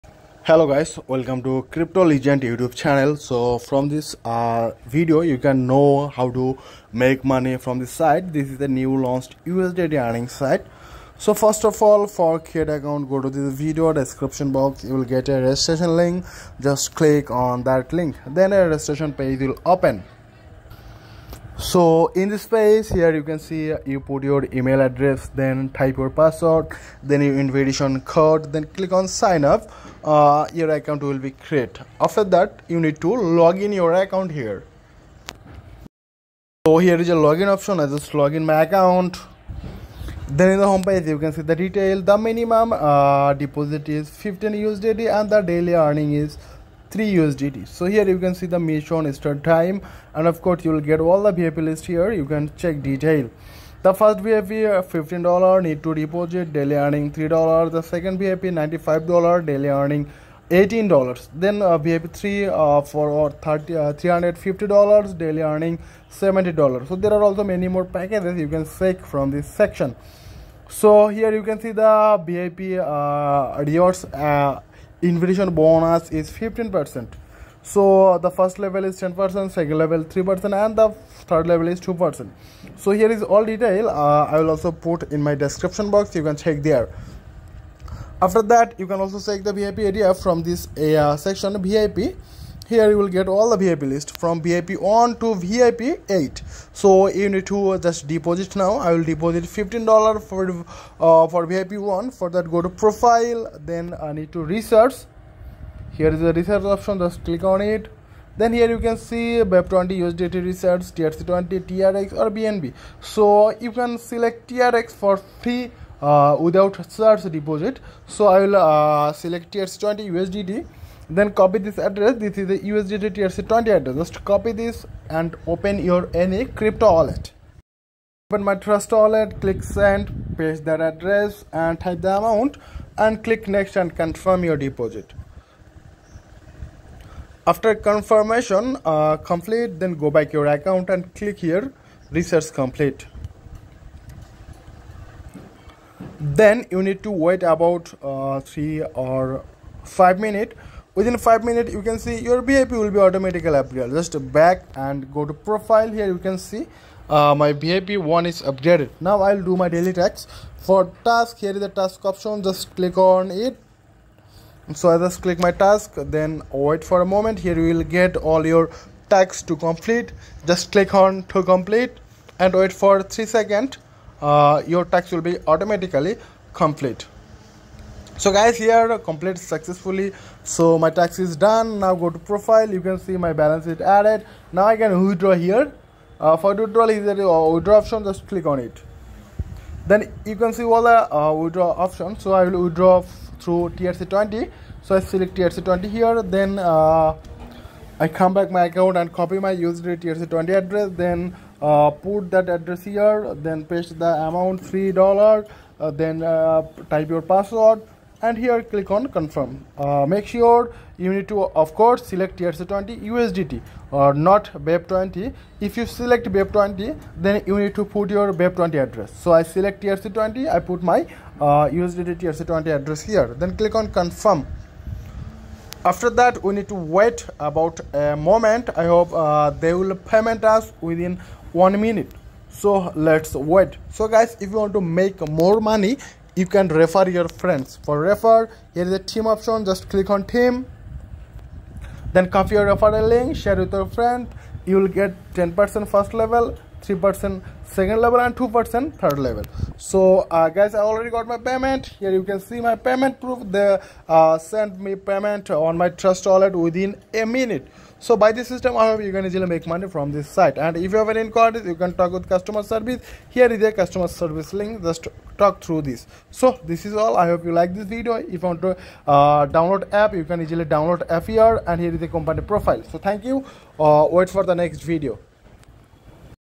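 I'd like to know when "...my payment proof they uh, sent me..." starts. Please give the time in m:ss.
4:12.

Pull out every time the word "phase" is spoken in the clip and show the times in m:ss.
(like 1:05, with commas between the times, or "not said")
0:22.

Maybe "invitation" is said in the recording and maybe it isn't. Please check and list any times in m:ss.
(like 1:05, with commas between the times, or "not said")
0:27, 1:15.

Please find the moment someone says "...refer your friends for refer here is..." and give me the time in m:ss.
3:56.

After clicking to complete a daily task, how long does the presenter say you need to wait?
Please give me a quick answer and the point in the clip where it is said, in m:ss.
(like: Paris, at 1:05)
3 seconds, at 2:53.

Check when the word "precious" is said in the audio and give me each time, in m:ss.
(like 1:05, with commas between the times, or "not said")
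not said.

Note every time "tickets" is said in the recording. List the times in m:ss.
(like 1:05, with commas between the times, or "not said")
not said.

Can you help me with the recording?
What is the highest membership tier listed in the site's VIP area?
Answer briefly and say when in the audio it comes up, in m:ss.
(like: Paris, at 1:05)
VIP 8, at 1:35.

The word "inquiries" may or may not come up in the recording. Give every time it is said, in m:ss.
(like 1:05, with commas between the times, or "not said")
4:21.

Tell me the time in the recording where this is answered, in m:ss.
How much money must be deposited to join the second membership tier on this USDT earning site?
0:58.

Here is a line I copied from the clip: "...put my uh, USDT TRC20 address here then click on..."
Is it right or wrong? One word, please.
right.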